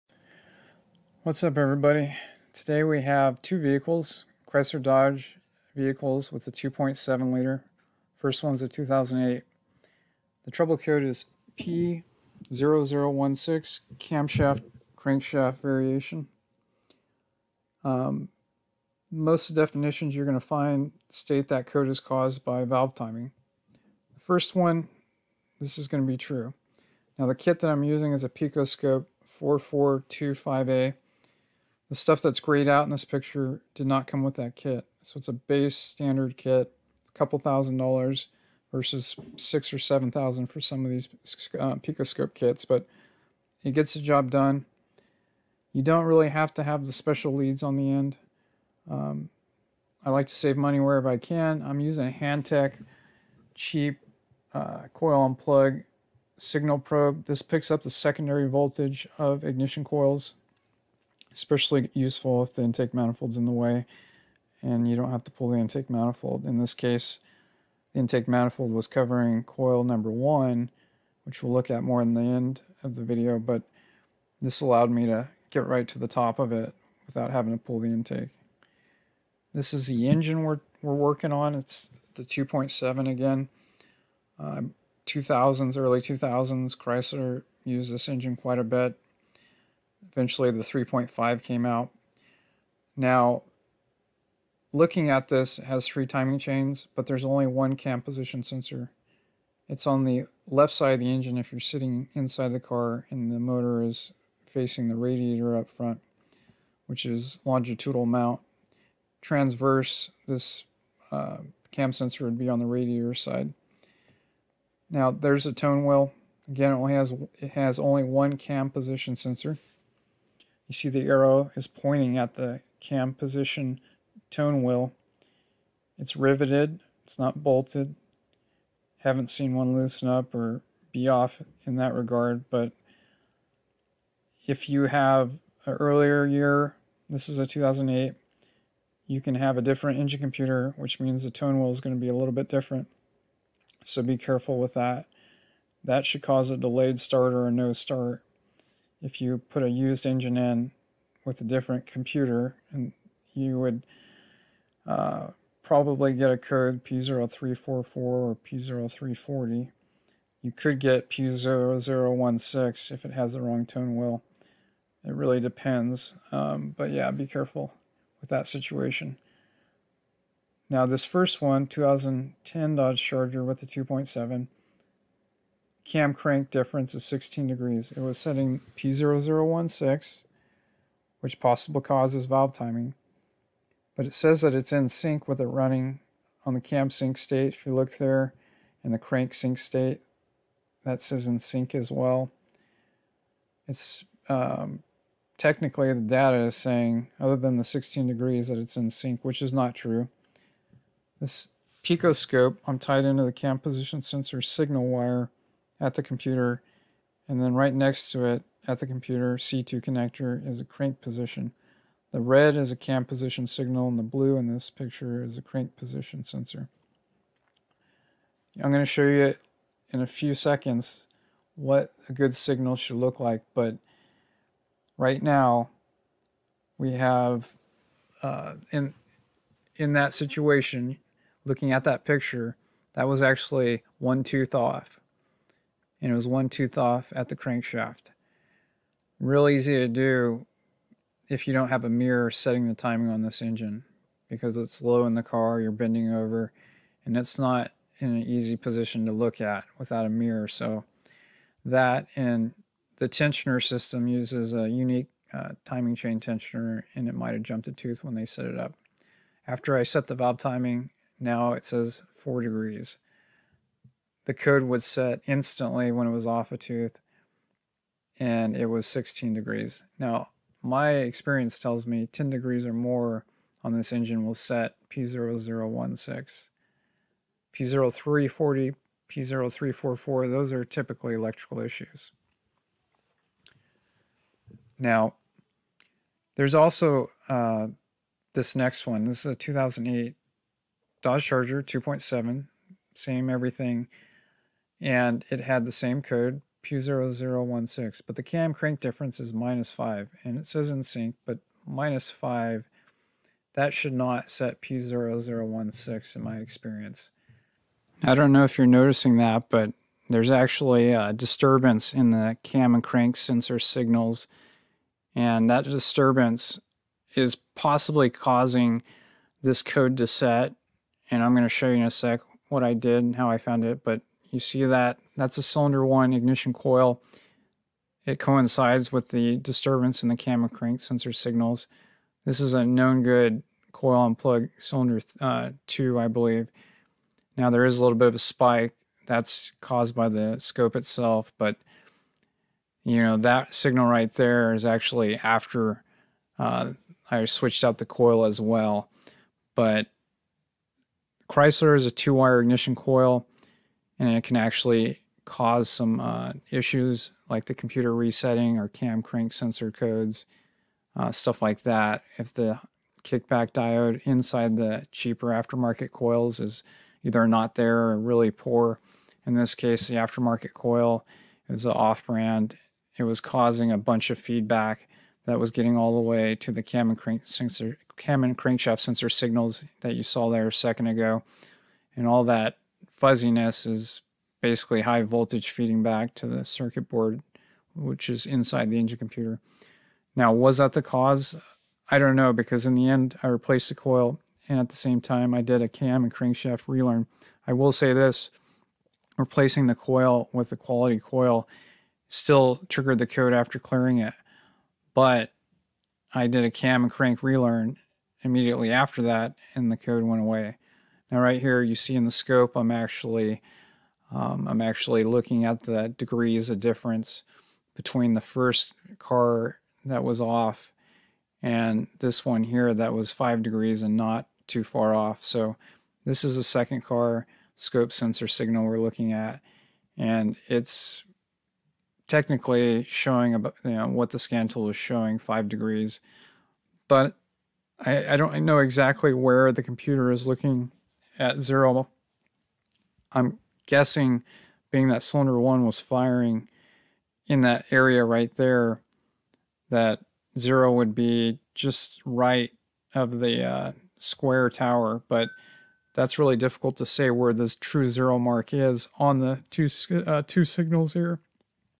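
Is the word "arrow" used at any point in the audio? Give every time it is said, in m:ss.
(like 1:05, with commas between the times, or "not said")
2:01.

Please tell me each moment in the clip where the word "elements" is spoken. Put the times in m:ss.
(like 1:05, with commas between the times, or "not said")
not said.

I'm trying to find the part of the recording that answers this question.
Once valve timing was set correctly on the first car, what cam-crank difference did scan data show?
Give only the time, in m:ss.
4:22.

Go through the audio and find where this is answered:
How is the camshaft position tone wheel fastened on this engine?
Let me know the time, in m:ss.
2:06.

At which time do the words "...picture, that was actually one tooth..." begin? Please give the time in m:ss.
3:52.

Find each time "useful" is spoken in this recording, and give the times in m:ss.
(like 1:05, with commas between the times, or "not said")
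1:01.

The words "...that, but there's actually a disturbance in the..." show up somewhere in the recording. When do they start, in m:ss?
5:09.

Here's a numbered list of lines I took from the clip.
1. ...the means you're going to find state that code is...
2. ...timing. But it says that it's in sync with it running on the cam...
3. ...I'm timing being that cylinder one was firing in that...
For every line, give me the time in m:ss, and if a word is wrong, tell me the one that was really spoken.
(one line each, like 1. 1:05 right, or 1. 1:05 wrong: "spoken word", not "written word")
1. 0:19 wrong: "definitions", not "means"
2. 3:02 right
3. 7:23 wrong: "guessing", not "timing".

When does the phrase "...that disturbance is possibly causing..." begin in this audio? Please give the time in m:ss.
5:15.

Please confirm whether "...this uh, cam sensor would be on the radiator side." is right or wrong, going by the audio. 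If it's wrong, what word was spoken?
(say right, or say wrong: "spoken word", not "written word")
right.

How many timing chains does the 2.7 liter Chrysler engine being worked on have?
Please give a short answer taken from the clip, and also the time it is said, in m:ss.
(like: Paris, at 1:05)
3, at 1:35.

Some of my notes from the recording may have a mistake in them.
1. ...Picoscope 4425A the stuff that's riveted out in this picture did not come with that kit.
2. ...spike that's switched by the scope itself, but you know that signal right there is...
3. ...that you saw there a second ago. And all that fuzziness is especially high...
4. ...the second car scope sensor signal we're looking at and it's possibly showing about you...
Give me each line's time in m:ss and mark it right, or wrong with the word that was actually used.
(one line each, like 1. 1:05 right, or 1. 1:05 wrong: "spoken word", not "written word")
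1. 0:28 wrong: "grayed", not "riveted"
2. 5:38 wrong: "caused", not "switched"
3. 6:19 wrong: "basically", not "especially"
4. 7:06 wrong: "technically", not "possibly".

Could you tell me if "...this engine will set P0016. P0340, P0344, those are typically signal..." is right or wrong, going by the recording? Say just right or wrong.
wrong.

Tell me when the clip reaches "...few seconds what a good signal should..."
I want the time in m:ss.
3:40.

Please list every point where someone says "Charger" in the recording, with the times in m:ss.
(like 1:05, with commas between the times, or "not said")
2:53, 4:51.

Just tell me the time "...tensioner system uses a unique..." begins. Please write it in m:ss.
4:13.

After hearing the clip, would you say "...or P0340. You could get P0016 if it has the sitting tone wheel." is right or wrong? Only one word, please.
wrong.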